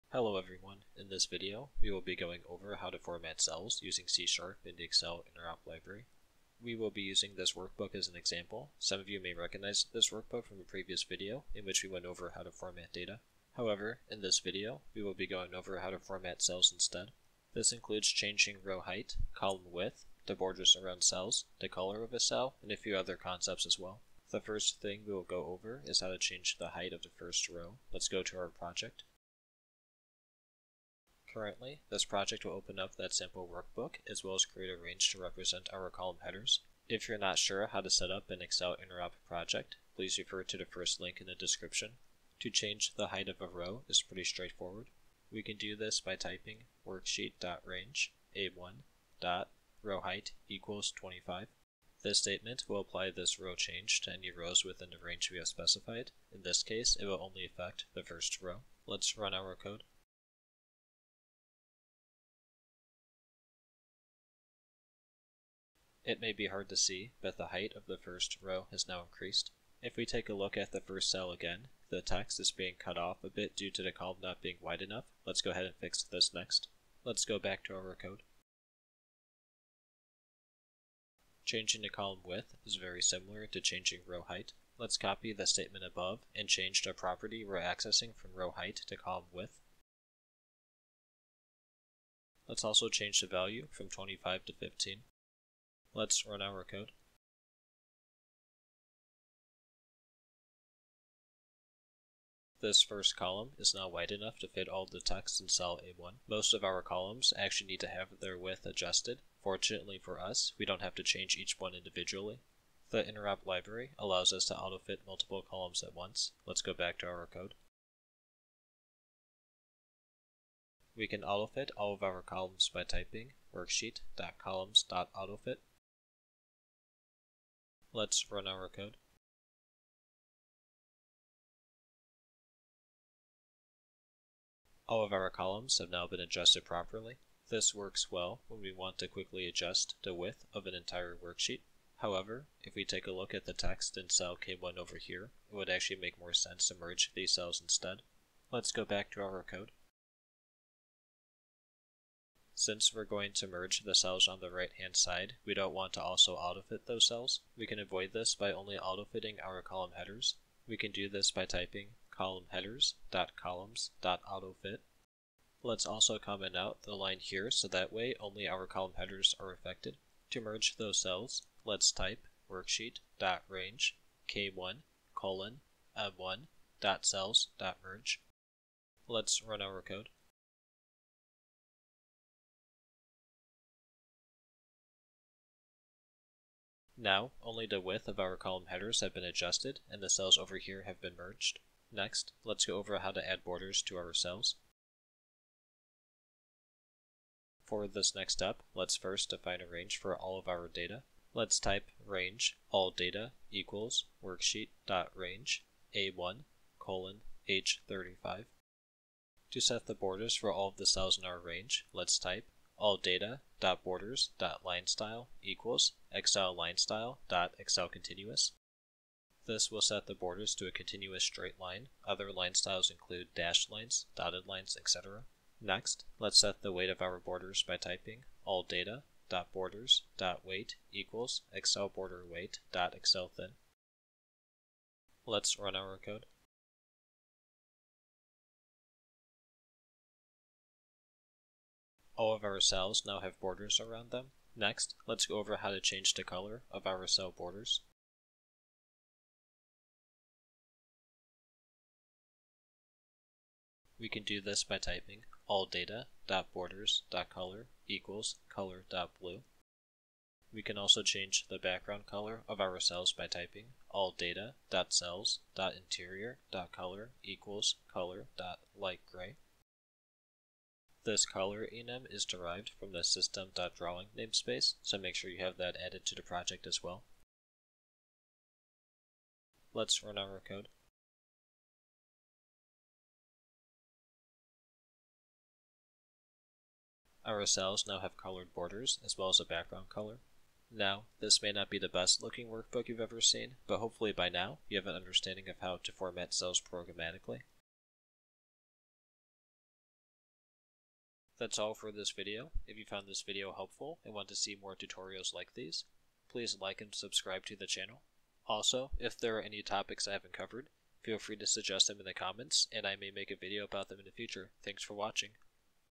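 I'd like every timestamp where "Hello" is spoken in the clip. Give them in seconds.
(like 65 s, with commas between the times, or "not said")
0 s.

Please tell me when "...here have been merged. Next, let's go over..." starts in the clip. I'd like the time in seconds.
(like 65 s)
190 s.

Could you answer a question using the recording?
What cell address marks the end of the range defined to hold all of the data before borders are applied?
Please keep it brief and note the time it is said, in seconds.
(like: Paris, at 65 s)
H35, at 207 s.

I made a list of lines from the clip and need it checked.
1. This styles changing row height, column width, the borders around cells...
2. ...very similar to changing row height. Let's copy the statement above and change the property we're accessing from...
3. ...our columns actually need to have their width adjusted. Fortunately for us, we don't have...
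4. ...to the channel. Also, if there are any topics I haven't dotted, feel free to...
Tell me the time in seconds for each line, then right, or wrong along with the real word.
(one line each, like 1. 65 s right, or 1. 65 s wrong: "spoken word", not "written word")
1. 17 s wrong: "includes", not "styles"
2. 82 s right
3. 106 s right
4. 307 s wrong: "covered", not "dotted".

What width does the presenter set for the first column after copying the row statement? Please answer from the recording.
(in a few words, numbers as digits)
15.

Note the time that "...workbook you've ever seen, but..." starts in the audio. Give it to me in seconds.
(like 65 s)
292 s.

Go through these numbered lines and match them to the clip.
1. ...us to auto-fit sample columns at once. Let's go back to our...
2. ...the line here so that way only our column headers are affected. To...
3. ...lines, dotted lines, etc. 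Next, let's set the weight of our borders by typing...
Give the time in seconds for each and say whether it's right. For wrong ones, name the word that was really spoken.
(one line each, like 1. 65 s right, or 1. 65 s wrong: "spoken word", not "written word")
1. 114 s wrong: "multiple", not "sample"
2. 166 s right
3. 223 s right.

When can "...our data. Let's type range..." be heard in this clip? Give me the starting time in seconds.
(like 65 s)
200 s.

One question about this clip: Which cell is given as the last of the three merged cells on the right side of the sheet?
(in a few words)
M1.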